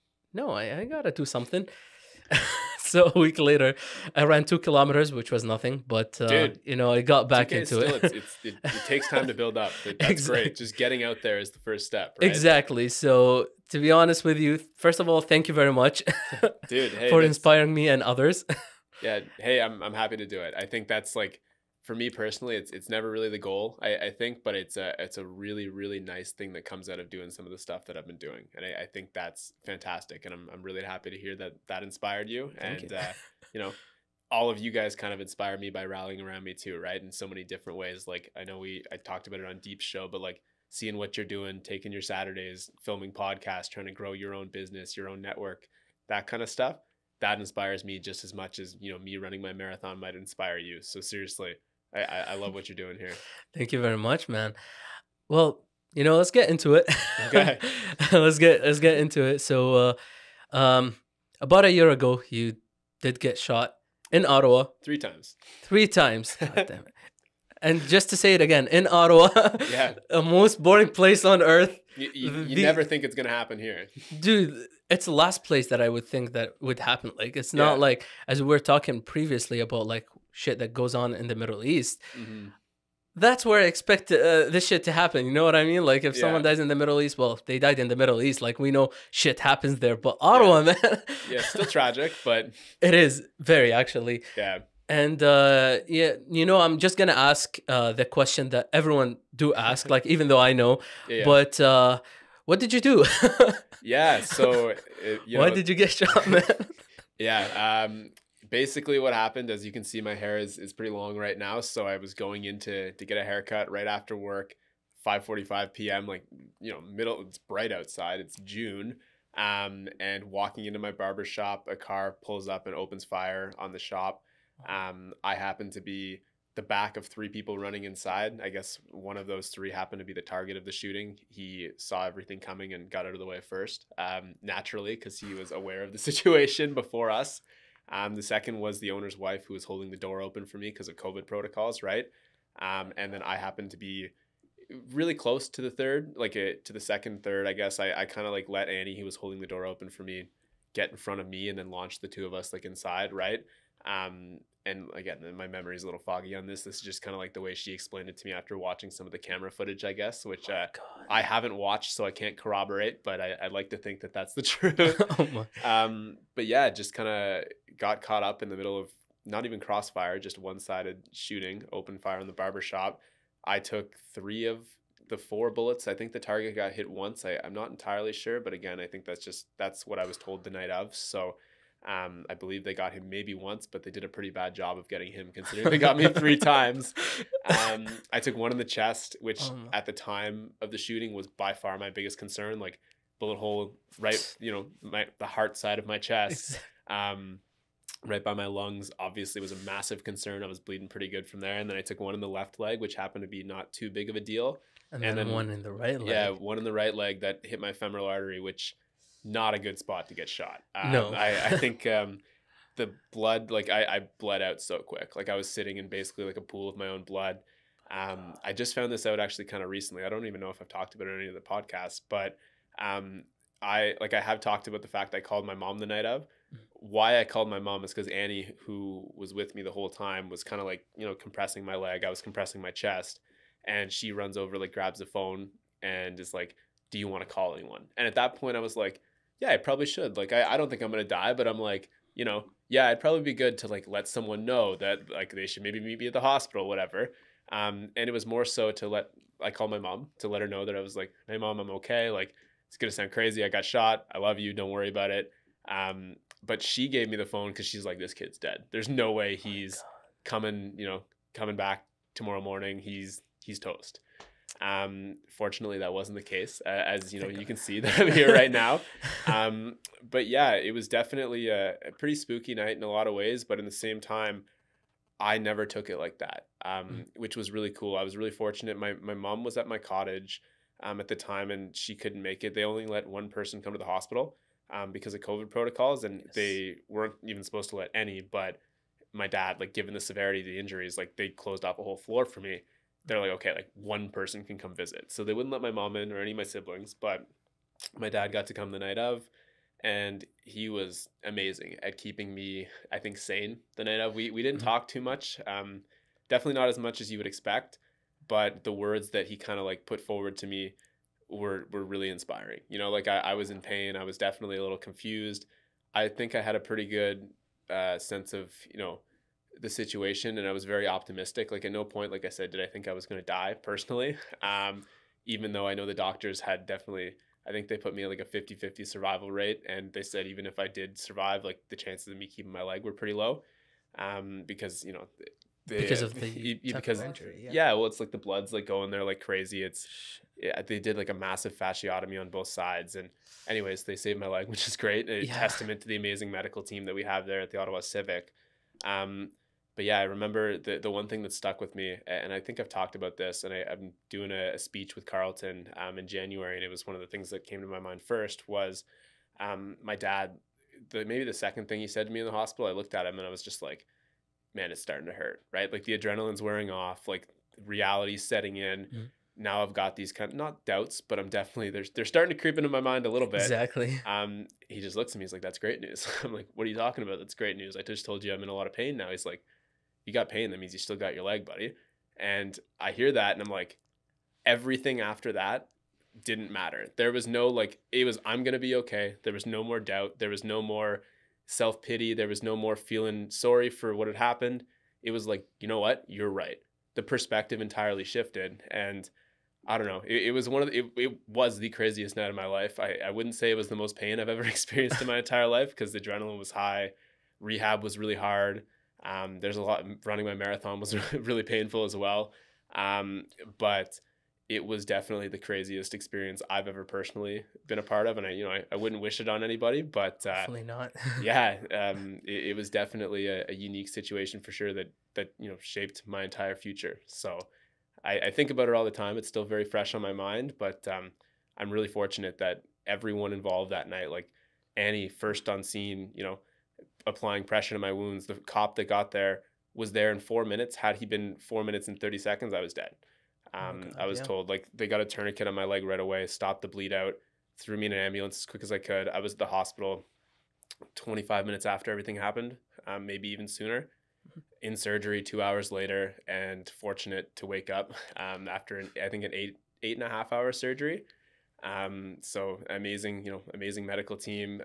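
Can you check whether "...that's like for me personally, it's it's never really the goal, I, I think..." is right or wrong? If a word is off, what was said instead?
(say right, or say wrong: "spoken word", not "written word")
right.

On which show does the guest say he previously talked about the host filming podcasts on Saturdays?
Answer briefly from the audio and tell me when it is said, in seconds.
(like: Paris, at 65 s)
Deep Show, at 39 s.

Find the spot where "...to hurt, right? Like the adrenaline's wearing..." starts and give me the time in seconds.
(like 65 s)
365 s.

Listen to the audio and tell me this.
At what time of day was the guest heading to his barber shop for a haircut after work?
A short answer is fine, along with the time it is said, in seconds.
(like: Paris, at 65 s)
5:45 p.m., at 115 s.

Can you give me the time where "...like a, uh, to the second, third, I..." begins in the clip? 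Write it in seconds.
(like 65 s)
146 s.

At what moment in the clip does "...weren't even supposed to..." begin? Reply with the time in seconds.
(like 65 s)
286 s.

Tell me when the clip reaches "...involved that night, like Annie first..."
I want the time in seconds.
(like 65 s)
433 s.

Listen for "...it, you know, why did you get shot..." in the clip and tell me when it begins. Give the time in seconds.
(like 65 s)
105 s.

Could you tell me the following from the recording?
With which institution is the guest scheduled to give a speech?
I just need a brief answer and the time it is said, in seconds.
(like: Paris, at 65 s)
Carleton, at 355 s.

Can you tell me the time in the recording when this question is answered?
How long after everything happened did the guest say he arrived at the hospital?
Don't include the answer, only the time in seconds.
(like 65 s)
450 s.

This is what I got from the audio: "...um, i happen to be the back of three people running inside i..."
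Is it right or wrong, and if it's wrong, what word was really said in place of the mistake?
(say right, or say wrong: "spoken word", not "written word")
right.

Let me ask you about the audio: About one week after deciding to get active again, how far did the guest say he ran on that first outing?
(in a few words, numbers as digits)
2 kilometers.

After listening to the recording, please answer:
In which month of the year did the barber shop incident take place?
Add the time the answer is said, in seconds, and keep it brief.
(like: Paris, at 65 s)
June, at 118 s.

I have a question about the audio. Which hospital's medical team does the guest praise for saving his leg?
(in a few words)
Ottawa Civic.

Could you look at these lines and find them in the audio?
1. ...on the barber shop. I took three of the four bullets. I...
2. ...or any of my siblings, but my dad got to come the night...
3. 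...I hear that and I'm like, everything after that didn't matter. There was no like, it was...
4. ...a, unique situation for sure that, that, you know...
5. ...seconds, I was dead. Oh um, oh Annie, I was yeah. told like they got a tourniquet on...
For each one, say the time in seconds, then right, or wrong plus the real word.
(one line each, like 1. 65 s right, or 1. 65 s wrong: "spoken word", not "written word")
1. 172 s right
2. 296 s right
3. 382 s right
4. 423 s right
5. 442 s wrong: "God", not "Annie".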